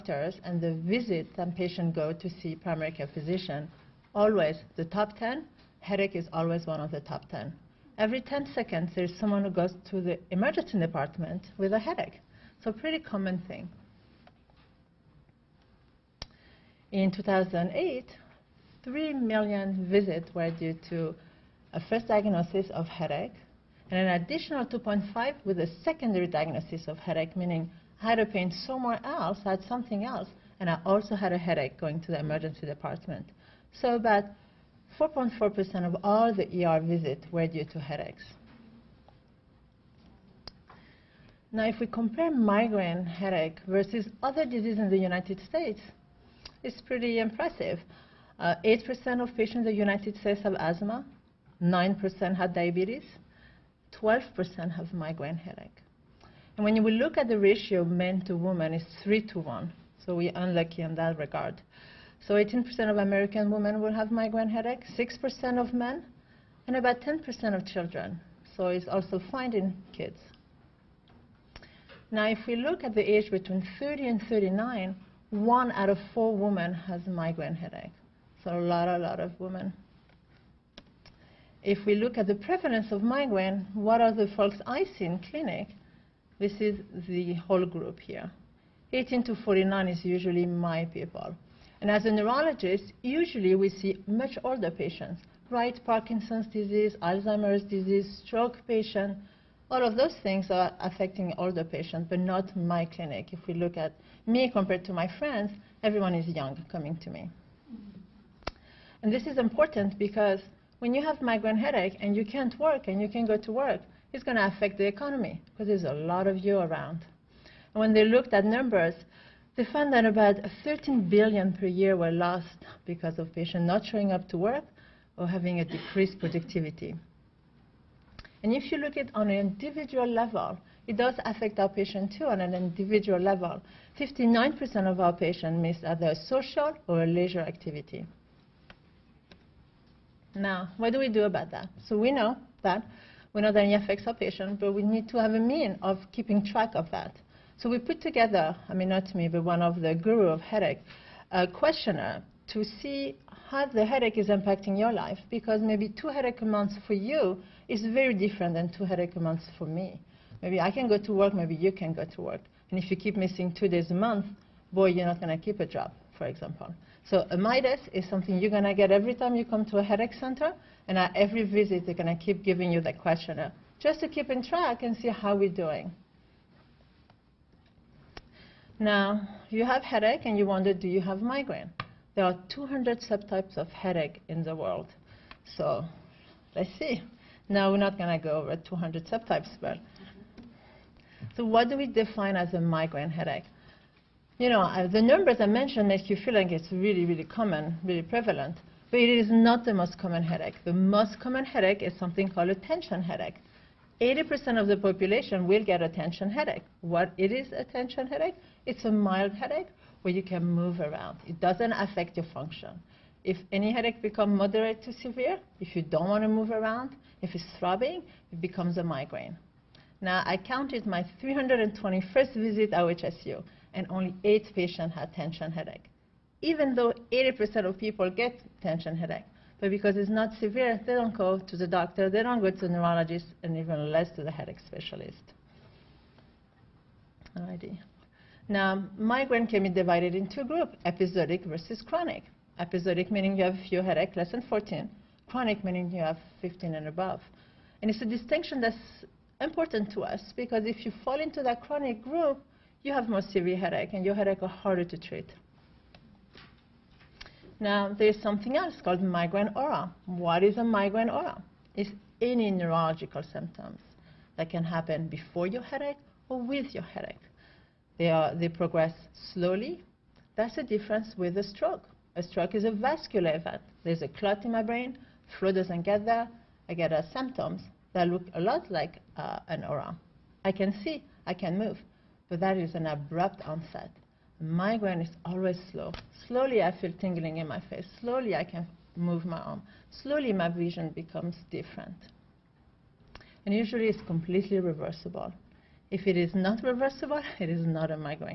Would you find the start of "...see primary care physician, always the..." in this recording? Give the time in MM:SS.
00:02.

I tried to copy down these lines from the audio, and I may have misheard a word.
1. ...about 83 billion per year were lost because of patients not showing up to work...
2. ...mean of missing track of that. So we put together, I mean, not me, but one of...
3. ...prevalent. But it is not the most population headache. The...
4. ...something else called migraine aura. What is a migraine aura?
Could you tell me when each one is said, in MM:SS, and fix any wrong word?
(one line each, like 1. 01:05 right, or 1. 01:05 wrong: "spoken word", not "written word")
1. 02:00 wrong: "13", not "83"
2. 02:25 wrong: "keeping", not "missing"
3. 03:18 wrong: "common", not "population"
4. 04:18 right.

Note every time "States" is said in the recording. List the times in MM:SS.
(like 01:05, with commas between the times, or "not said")
00:45, 00:50.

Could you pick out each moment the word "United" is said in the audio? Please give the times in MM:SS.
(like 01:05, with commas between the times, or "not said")
00:44, 00:49.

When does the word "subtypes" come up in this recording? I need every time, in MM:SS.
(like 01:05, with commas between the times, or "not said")
03:03, 03:09.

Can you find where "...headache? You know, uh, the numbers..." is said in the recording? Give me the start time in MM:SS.
03:13.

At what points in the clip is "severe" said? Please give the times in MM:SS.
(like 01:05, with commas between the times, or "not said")
03:34, 03:50, 04:13.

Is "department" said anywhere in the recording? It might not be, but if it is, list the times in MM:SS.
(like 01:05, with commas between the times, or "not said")
00:10, 00:32.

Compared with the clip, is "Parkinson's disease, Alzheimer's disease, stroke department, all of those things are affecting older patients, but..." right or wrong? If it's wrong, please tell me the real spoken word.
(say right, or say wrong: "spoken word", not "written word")
wrong: "patient", not "department".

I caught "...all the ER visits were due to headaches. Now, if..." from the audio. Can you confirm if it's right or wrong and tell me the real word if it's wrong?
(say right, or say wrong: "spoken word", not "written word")
right.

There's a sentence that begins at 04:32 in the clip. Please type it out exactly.
A stroke is a vascular event.